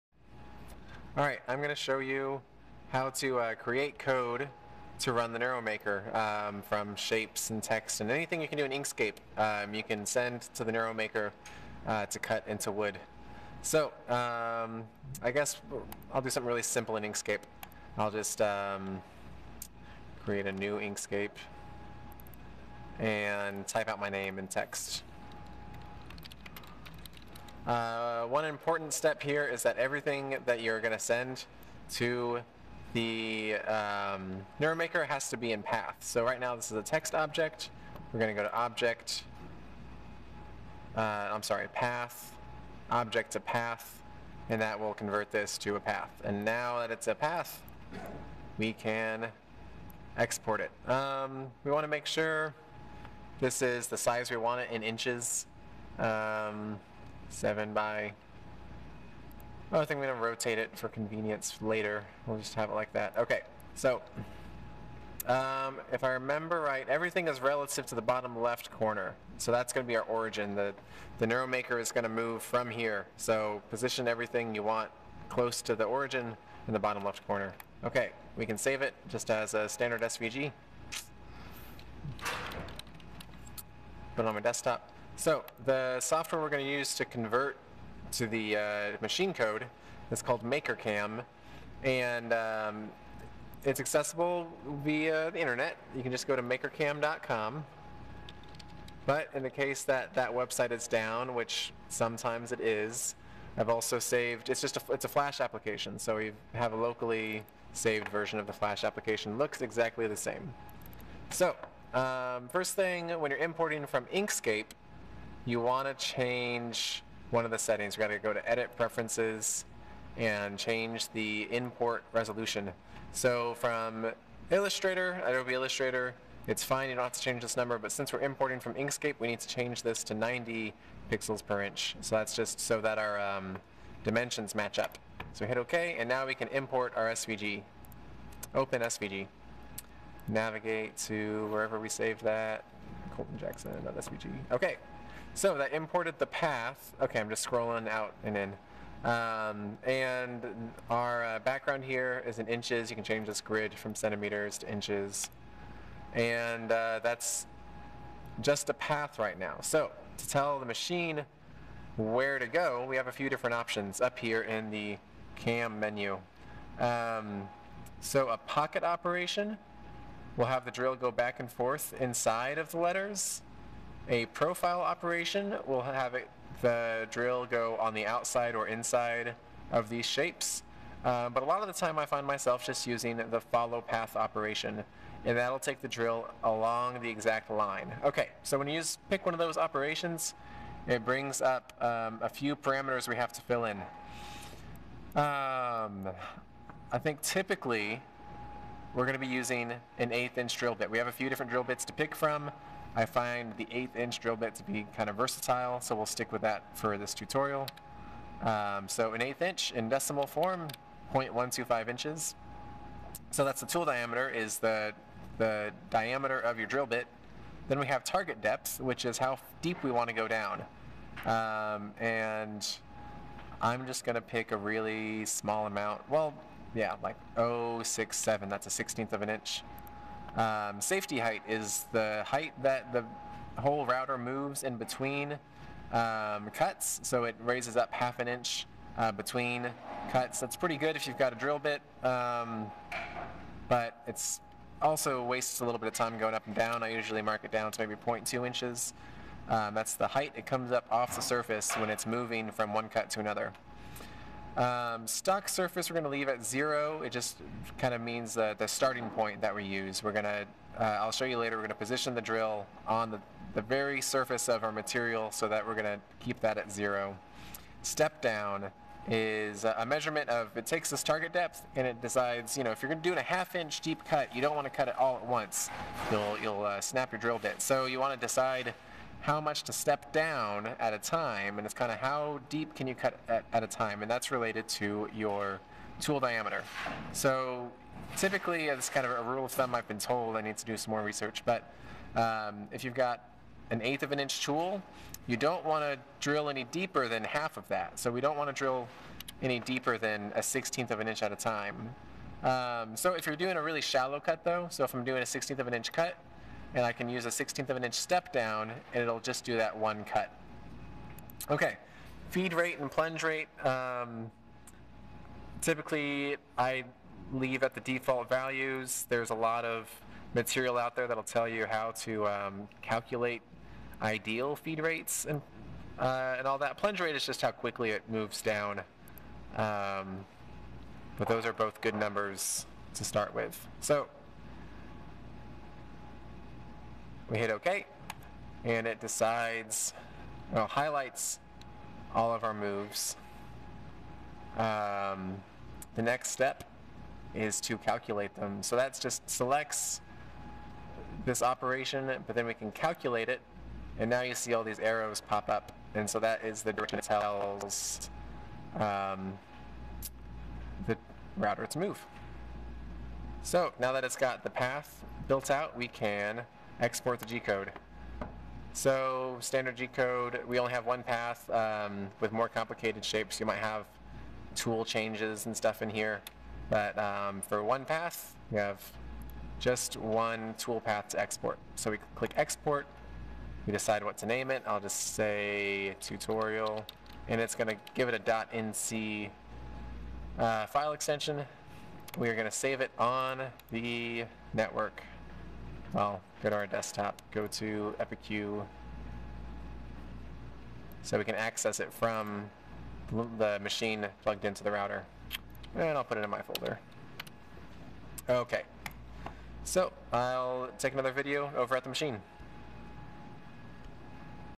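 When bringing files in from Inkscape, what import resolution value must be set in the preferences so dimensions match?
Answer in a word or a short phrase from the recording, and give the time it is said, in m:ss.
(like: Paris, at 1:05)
90 pixels per inch, at 2:10.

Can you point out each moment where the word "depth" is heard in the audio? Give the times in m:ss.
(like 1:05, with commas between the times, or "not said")
3:38, 4:31.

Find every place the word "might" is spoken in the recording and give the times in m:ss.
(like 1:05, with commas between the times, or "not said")
6:13.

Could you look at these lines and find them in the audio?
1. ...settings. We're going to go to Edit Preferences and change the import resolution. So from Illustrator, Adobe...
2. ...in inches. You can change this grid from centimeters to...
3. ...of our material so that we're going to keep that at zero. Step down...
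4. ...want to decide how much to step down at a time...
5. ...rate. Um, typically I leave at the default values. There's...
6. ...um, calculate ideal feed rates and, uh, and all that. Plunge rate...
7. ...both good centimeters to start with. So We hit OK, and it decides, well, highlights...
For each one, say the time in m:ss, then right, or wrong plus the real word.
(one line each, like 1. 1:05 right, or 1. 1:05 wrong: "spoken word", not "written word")
1. 1:57 right
2. 2:32 right
3. 4:24 right
4. 4:37 right
5. 5:13 right
6. 5:22 right
7. 5:31 wrong: "numbers", not "centimeters".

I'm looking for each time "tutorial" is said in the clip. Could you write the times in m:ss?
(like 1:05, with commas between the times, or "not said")
3:27, 6:26.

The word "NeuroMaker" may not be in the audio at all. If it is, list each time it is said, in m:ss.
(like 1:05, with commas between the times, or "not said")
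0:05, 0:10, 0:34, 1:11.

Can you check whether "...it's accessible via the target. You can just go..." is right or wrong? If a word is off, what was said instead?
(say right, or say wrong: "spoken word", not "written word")
wrong: "internet", not "target".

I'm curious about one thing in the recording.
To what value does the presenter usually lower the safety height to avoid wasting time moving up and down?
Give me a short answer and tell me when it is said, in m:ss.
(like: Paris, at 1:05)
0.2 inches, at 4:07.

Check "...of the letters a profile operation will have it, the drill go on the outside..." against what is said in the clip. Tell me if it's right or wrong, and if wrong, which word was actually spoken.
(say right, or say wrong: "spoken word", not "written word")
right.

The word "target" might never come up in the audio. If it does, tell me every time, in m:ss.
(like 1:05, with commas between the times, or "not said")
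3:38, 4:31.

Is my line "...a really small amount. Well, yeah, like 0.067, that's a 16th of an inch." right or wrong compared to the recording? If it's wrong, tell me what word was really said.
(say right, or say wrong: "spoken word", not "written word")
right.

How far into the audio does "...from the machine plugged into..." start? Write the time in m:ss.
6:41.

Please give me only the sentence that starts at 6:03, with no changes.
So now that it's got the path built out, we can export the G-code.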